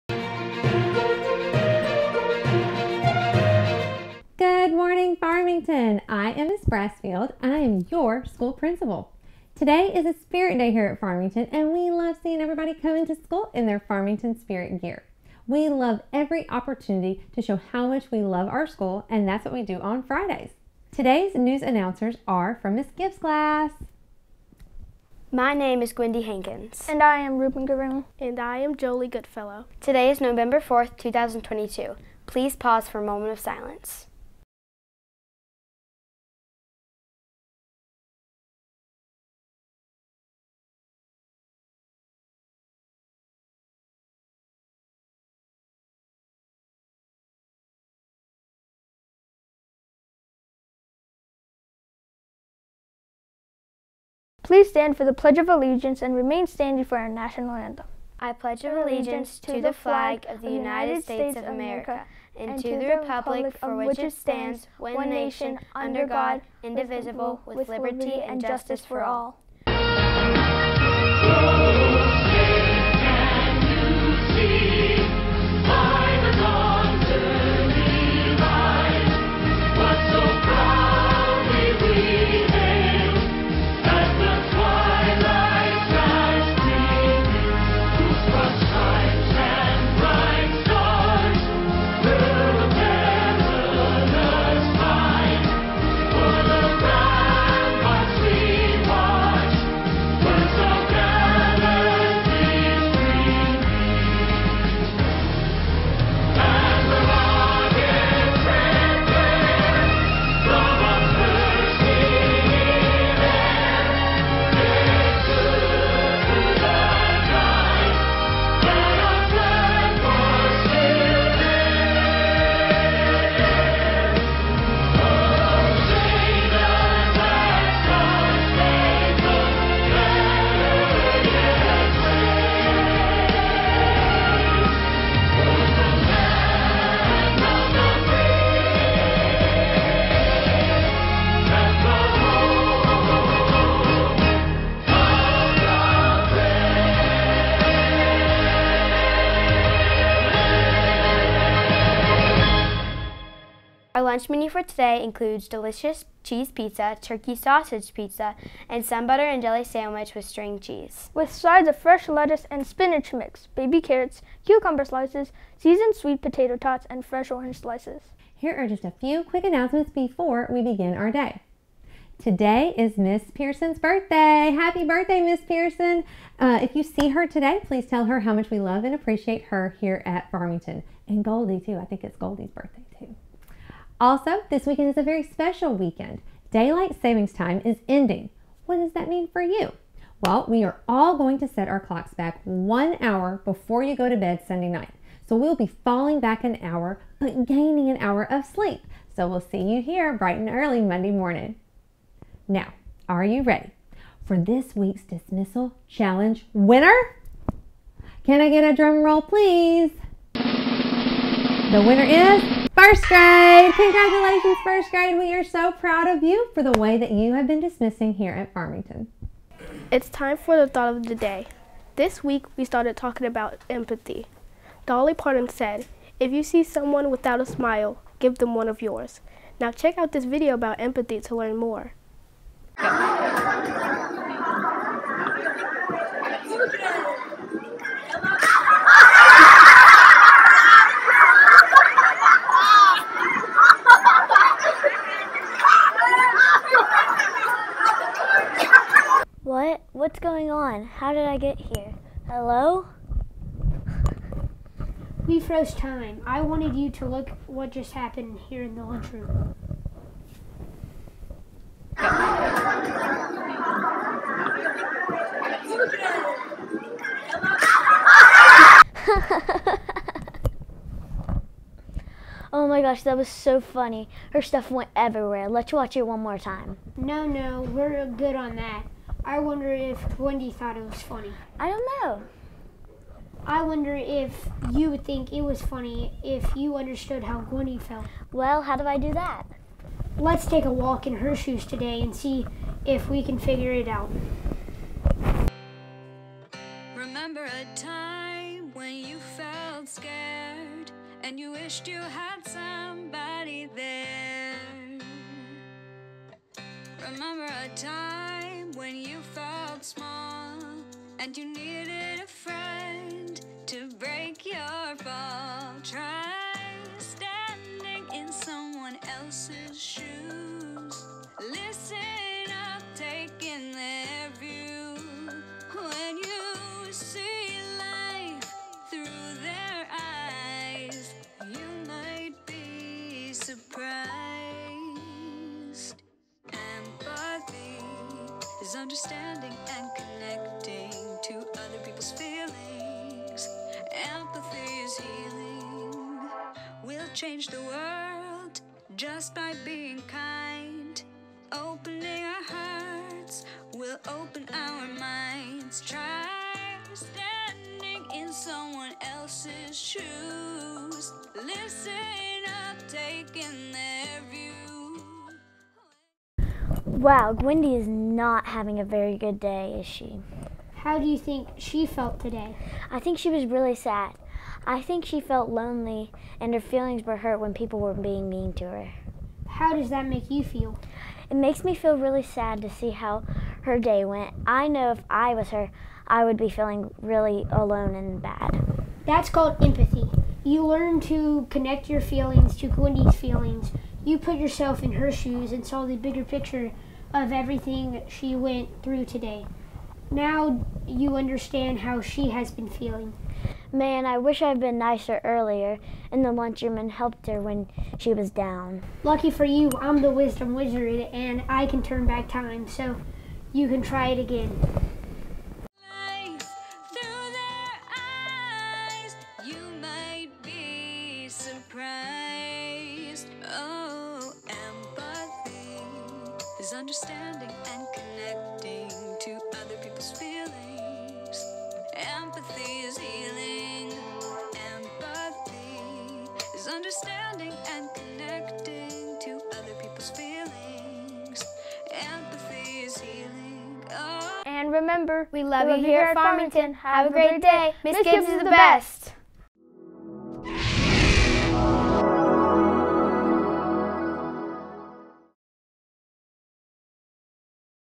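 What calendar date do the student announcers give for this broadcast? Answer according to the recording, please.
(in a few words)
November 4th, 2022.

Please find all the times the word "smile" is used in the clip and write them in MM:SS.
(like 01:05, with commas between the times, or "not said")
03:47.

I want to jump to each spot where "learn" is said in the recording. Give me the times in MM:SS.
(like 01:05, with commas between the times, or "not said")
03:51, 06:30.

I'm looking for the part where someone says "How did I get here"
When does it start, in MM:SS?
04:10.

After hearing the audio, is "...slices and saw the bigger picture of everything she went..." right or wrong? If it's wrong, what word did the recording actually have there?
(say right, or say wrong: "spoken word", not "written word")
wrong: "shoes", not "slices".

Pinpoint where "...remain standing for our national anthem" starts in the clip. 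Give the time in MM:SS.
00:56.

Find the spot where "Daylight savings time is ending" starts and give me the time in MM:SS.
03:06.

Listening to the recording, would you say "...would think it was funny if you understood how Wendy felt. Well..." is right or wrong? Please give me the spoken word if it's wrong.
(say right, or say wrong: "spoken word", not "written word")
right.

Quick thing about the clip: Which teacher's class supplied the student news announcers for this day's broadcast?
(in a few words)
Miss Gibbs.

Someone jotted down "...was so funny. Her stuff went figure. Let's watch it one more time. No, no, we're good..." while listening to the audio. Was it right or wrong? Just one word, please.
wrong.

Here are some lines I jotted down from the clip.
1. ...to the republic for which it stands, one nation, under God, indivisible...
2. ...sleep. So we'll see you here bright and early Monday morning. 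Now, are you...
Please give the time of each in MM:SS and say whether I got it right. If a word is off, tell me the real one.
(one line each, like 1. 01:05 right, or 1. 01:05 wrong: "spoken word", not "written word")
1. 01:02 right
2. 03:18 right.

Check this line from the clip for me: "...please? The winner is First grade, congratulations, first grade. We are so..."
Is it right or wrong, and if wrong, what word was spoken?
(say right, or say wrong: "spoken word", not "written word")
right.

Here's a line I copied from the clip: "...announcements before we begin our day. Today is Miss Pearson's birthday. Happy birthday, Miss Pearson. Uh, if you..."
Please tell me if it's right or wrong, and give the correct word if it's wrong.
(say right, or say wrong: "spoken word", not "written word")
right.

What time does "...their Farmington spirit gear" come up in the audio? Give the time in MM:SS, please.
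00:13.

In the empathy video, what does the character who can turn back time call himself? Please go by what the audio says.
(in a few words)
the wisdom wizard.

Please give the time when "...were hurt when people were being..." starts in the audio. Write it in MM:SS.
06:17.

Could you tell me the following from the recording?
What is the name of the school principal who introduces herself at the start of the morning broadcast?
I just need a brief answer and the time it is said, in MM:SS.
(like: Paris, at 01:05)
Miss Brassfield, at 00:06.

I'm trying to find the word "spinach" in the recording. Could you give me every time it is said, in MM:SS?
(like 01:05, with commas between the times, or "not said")
02:42.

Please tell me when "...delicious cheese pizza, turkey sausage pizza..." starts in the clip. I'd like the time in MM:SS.
02:35.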